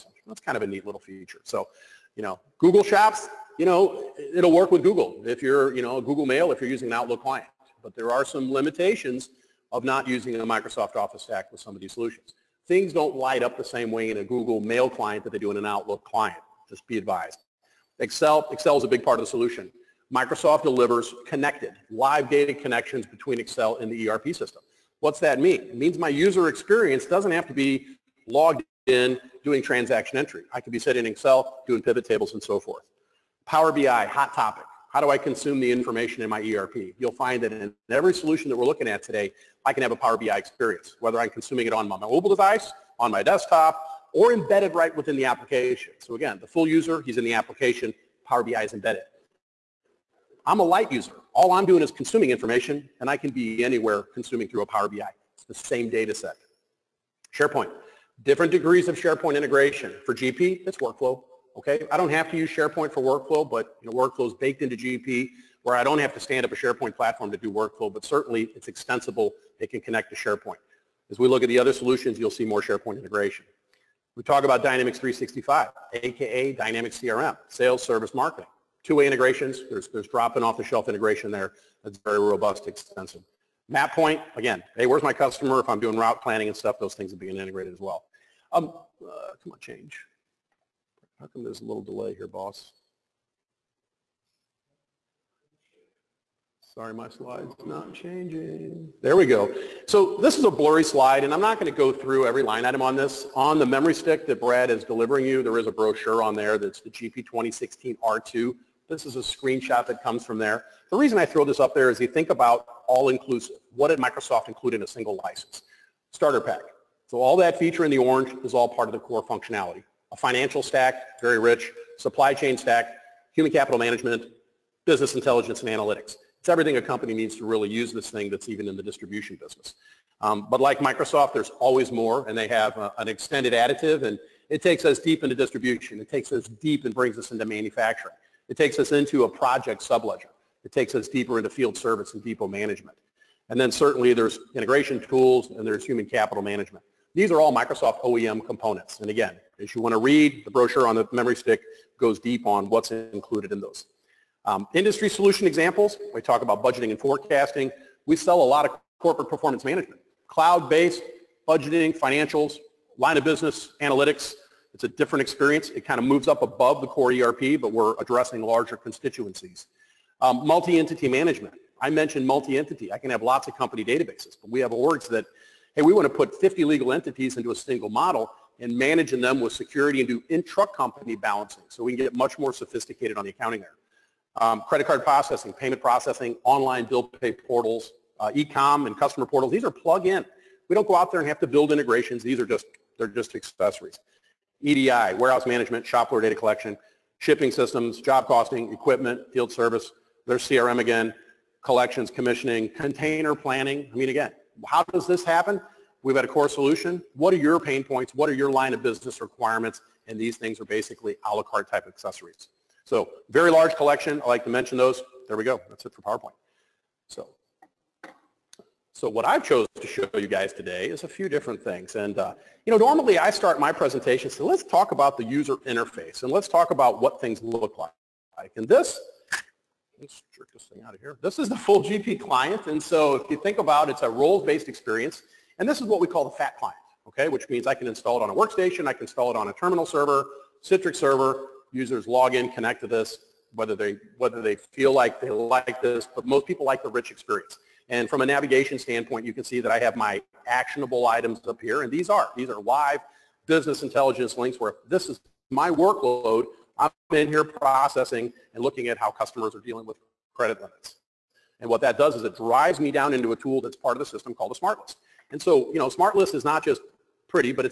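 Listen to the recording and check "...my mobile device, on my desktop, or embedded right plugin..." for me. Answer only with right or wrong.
wrong.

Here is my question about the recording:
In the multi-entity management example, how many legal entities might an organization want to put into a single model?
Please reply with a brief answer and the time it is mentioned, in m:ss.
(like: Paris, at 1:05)
50, at 2:56.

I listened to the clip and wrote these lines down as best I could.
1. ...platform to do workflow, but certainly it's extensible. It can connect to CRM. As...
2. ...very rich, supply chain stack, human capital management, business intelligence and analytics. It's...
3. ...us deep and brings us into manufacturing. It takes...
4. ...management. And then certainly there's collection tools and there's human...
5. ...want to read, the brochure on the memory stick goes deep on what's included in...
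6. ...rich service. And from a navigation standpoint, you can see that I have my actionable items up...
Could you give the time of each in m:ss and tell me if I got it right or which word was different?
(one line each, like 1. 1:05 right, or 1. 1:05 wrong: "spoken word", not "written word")
1. 1:06 wrong: "SharePoint", not "CRM"
2. 2:01 right
3. 2:16 right
4. 2:22 wrong: "integration", not "collection"
5. 2:29 right
6. 4:06 wrong: "experience", not "service".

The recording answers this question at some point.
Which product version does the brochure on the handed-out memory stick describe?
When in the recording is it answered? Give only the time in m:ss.
1:46.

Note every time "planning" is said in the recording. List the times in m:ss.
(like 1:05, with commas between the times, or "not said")
1:26, 3:23.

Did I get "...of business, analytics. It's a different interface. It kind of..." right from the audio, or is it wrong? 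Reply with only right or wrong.
wrong.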